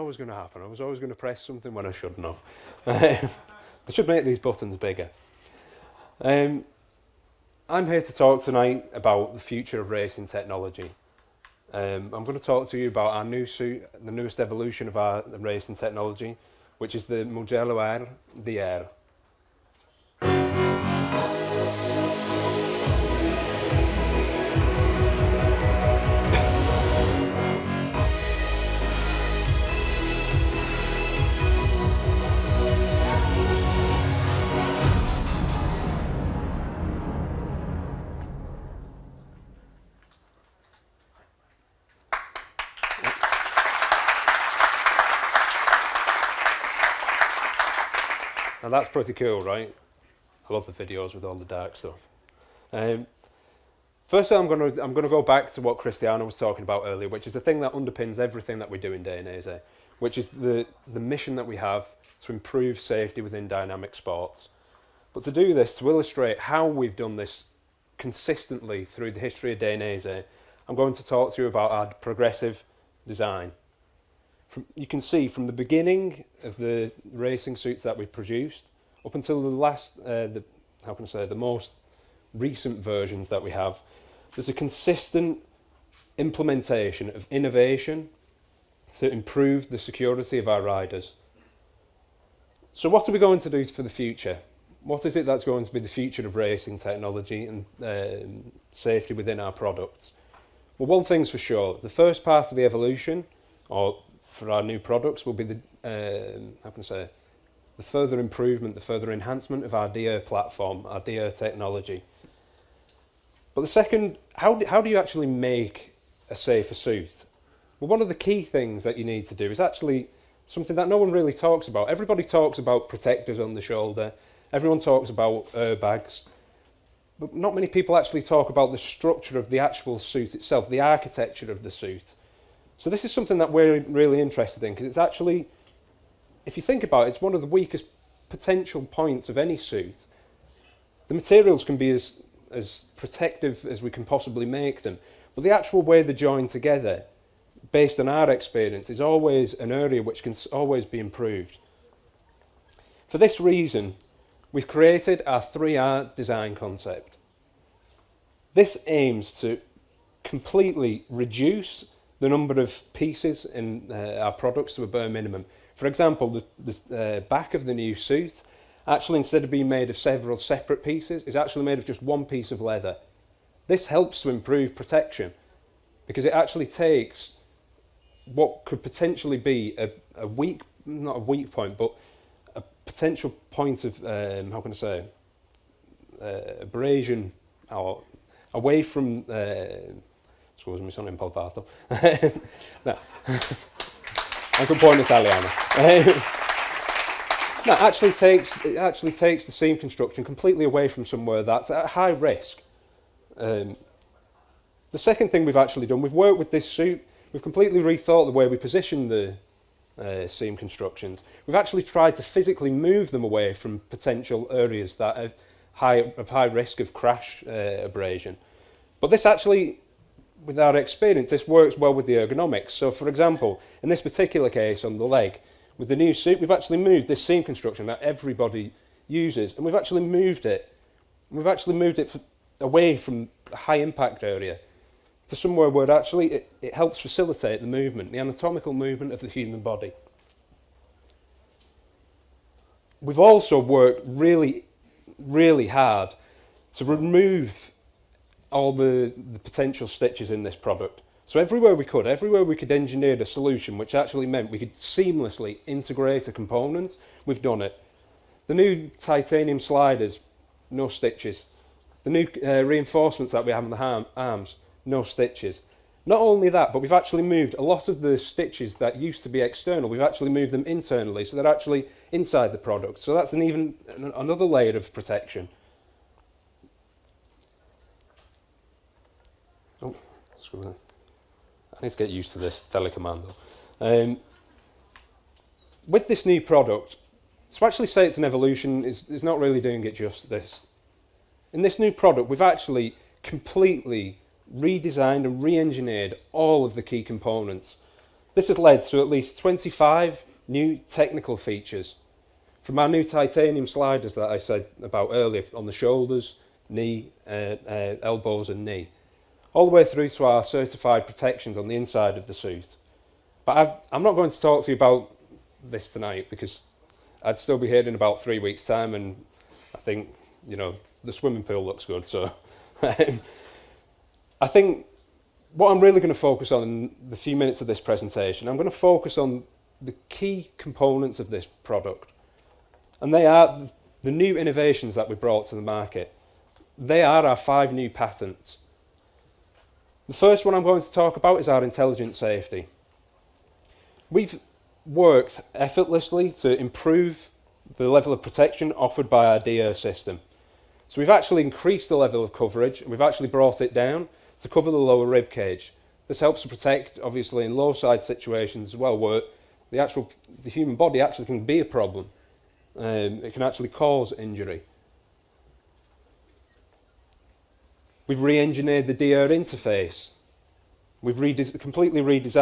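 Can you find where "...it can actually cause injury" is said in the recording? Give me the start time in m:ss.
6:03.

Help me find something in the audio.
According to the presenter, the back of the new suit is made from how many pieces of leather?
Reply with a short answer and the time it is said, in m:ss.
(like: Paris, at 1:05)
1, at 2:52.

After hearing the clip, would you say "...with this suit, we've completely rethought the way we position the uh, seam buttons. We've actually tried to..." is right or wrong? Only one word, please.
wrong.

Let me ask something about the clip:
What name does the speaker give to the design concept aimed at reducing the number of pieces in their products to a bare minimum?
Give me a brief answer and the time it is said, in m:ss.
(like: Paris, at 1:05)
3R design concept, at 2:35.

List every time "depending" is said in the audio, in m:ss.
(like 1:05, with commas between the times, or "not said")
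not said.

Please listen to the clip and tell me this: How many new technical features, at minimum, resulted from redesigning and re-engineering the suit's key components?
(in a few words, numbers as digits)
25.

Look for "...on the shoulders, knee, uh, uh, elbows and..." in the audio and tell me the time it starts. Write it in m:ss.
5:05.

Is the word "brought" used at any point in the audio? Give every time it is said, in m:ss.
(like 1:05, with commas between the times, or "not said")
5:35, 5:53.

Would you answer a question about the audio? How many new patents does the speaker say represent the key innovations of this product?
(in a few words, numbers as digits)
5.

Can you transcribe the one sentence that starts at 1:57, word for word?
Well, one of the key things that you need to do is actually something that no one really talks about.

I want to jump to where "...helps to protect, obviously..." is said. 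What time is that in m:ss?
5:56.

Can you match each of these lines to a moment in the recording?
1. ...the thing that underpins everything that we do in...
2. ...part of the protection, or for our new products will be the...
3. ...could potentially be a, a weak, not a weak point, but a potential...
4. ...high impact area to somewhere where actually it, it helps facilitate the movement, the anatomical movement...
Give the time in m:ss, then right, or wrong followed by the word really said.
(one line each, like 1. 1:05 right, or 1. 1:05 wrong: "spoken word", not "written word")
1. 0:57 right
2. 1:42 wrong: "evolution", not "protection"
3. 2:58 right
4. 3:53 right.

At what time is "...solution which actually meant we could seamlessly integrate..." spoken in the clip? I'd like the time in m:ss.
4:13.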